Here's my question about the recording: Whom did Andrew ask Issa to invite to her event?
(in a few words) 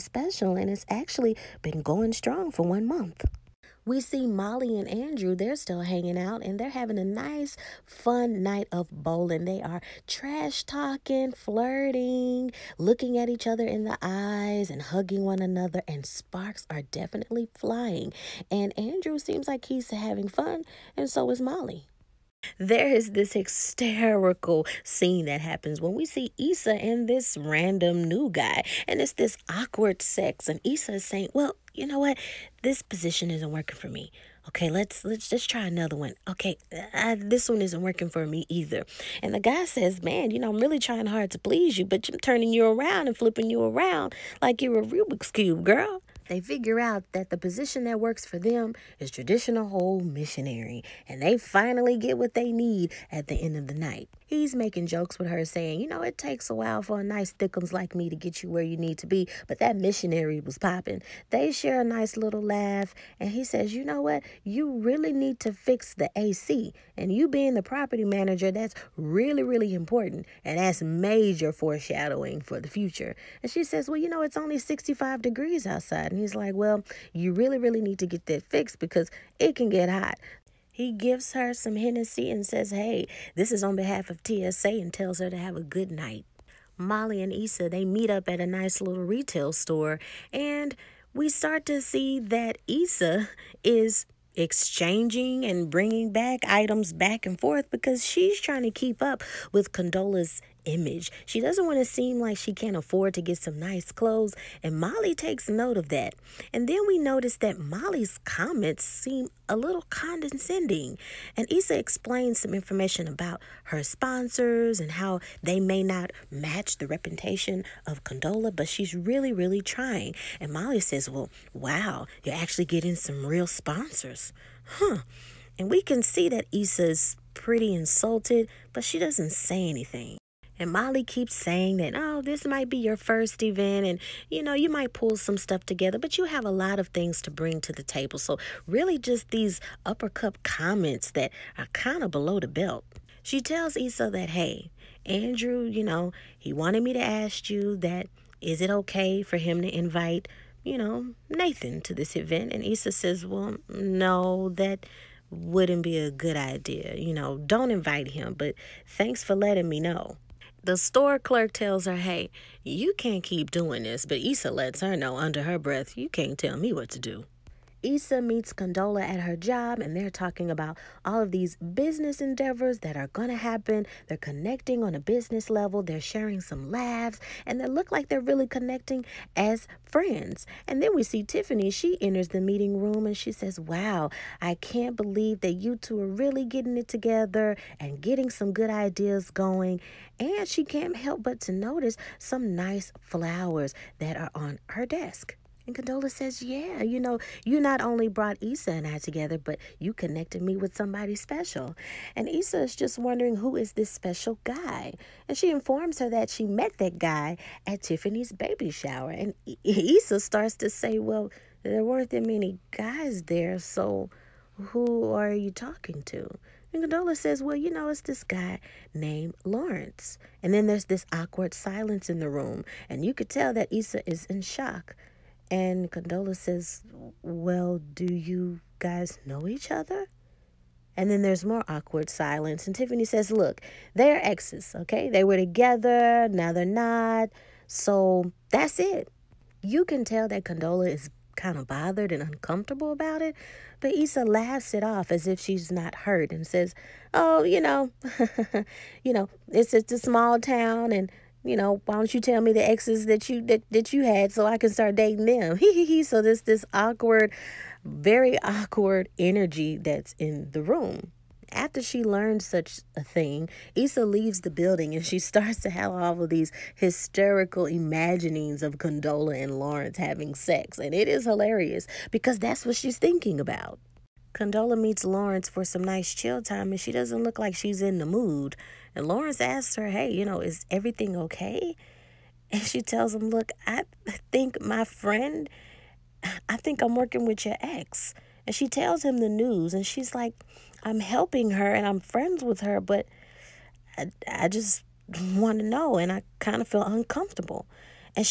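Nathan.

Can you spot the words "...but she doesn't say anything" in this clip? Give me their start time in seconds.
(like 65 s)
128 s.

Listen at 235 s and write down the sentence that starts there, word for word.
They were together, now they're not.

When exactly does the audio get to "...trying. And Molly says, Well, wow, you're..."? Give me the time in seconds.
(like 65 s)
119 s.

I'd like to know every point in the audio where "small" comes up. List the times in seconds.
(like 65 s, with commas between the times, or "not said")
249 s.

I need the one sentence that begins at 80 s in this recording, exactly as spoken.
He gives her some Hennessy and says, Hey, this is on behalf of TSA and tells her to have a good night.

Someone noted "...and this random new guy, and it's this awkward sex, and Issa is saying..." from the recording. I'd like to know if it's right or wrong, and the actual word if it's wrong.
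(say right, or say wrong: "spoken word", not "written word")
right.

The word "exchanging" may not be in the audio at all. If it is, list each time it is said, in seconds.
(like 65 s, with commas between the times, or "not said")
94 s.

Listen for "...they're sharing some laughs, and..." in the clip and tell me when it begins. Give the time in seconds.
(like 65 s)
175 s.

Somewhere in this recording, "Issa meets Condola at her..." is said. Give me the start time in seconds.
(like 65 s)
167 s.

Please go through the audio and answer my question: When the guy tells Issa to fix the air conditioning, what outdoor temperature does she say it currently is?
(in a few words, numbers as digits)
65 degrees.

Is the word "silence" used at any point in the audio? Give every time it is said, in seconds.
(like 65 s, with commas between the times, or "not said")
221 s, 232 s.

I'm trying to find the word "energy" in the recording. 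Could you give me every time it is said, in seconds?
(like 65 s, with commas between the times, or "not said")
259 s.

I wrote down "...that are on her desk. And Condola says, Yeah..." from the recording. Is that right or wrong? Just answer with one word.
right.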